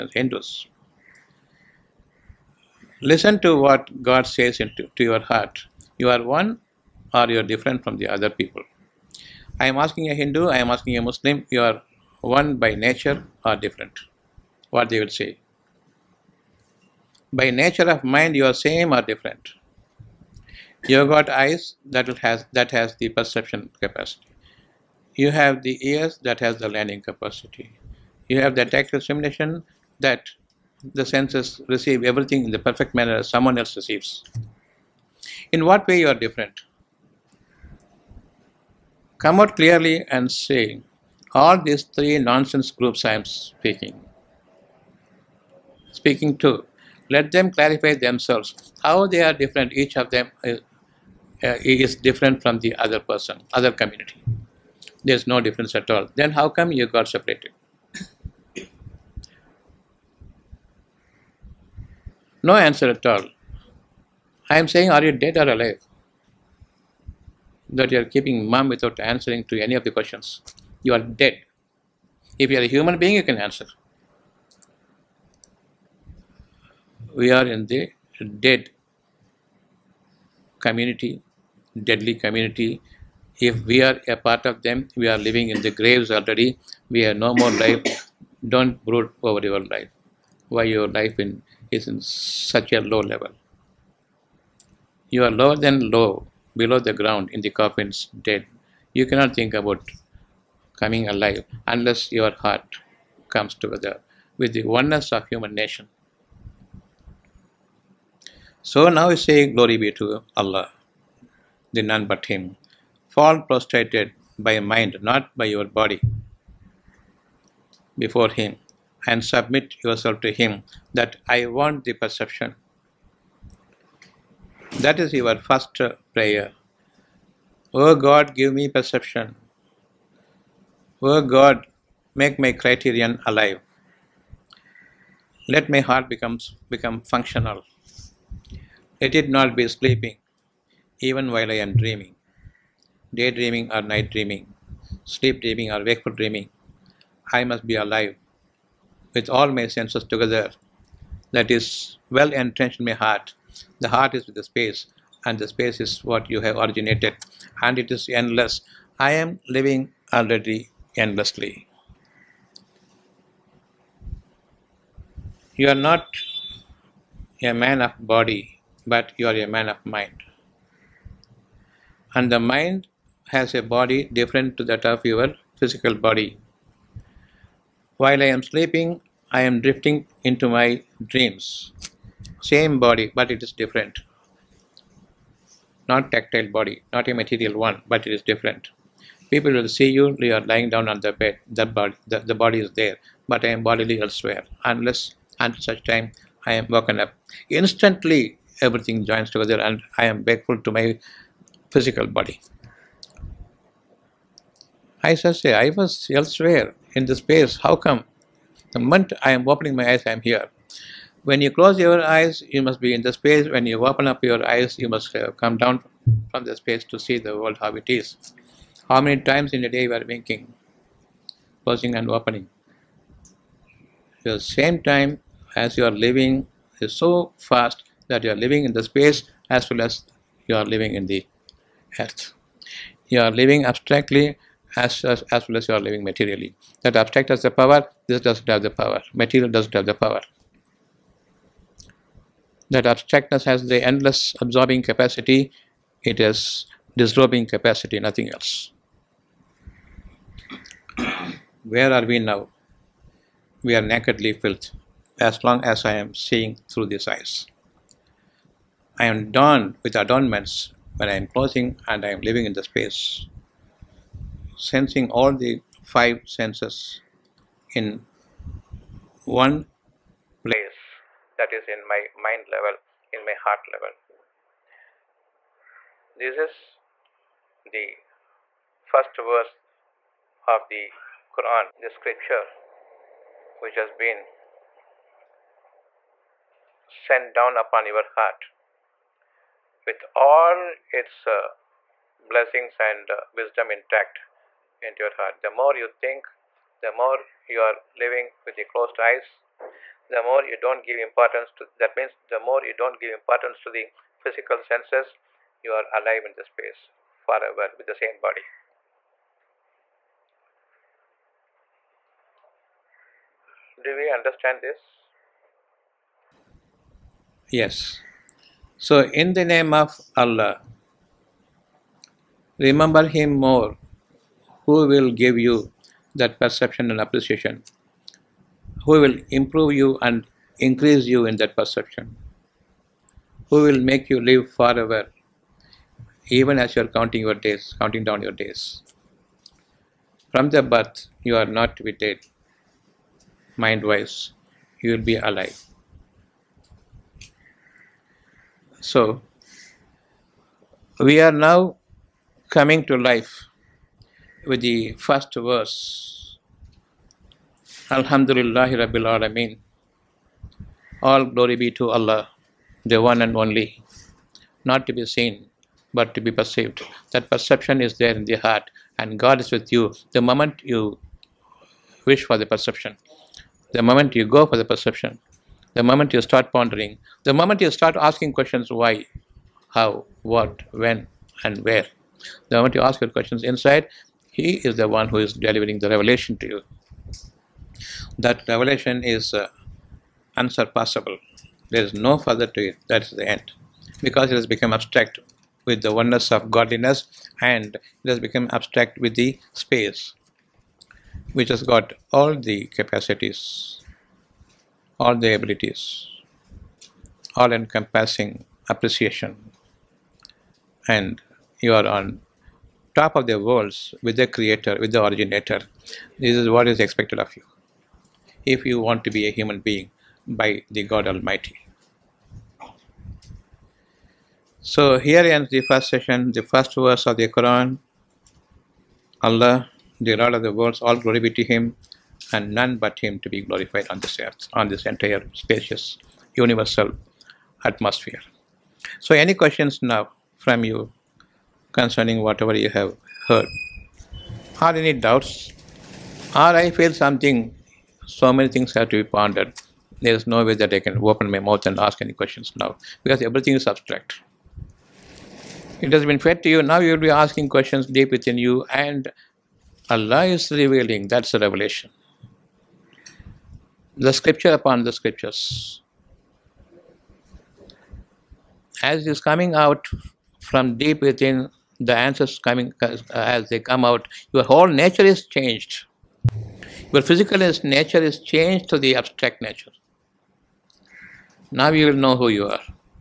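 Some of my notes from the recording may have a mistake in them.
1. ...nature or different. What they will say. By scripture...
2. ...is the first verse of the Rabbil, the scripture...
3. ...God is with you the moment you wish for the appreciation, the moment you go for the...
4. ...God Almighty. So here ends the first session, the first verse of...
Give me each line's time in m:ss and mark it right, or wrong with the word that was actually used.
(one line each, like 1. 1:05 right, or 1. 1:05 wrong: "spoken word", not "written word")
1. 0:12 wrong: "nature", not "scripture"
2. 4:36 wrong: "Quran", not "Rabbil"
3. 6:09 wrong: "perception", not "appreciation"
4. 7:00 right.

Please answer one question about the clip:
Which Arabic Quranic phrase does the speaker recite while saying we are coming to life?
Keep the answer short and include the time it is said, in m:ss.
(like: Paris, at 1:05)
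Alhamdulillah Rabbil Alameen, at 5:57.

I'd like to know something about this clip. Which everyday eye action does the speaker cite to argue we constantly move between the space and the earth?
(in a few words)
winking.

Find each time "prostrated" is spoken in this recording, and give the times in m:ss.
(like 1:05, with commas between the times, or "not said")
1:53.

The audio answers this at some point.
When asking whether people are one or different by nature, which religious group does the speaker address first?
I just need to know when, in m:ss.
0:00.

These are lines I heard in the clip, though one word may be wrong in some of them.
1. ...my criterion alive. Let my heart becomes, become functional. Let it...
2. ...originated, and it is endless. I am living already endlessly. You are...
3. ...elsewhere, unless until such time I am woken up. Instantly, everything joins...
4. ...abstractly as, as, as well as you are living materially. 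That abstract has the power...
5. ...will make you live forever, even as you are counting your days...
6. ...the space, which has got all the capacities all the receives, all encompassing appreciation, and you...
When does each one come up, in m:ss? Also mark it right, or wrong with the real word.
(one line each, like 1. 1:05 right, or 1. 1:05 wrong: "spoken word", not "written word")
1. 2:12 right
2. 2:36 right
3. 3:13 right
4. 3:53 right
5. 5:33 right
6. 6:39 wrong: "abilities", not "receives".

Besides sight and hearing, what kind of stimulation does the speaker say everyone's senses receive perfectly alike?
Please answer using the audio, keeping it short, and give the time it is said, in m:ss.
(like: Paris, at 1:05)
tactile stimulation, at 0:28.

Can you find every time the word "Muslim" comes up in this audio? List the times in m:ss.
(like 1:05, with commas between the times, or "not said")
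0:11.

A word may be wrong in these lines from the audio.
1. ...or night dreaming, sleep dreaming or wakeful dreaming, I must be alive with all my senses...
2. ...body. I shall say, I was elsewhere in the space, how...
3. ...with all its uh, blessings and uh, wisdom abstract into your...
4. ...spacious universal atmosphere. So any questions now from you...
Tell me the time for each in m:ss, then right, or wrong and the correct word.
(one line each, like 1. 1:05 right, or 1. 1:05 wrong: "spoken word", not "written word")
1. 2:23 right
2. 3:22 right
3. 4:49 wrong: "intact", not "abstract"
4. 7:15 right.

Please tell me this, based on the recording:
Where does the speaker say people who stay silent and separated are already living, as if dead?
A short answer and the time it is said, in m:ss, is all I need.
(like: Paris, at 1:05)
in the graves, at 1:25.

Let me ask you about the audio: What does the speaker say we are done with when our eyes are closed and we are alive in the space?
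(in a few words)
adornments.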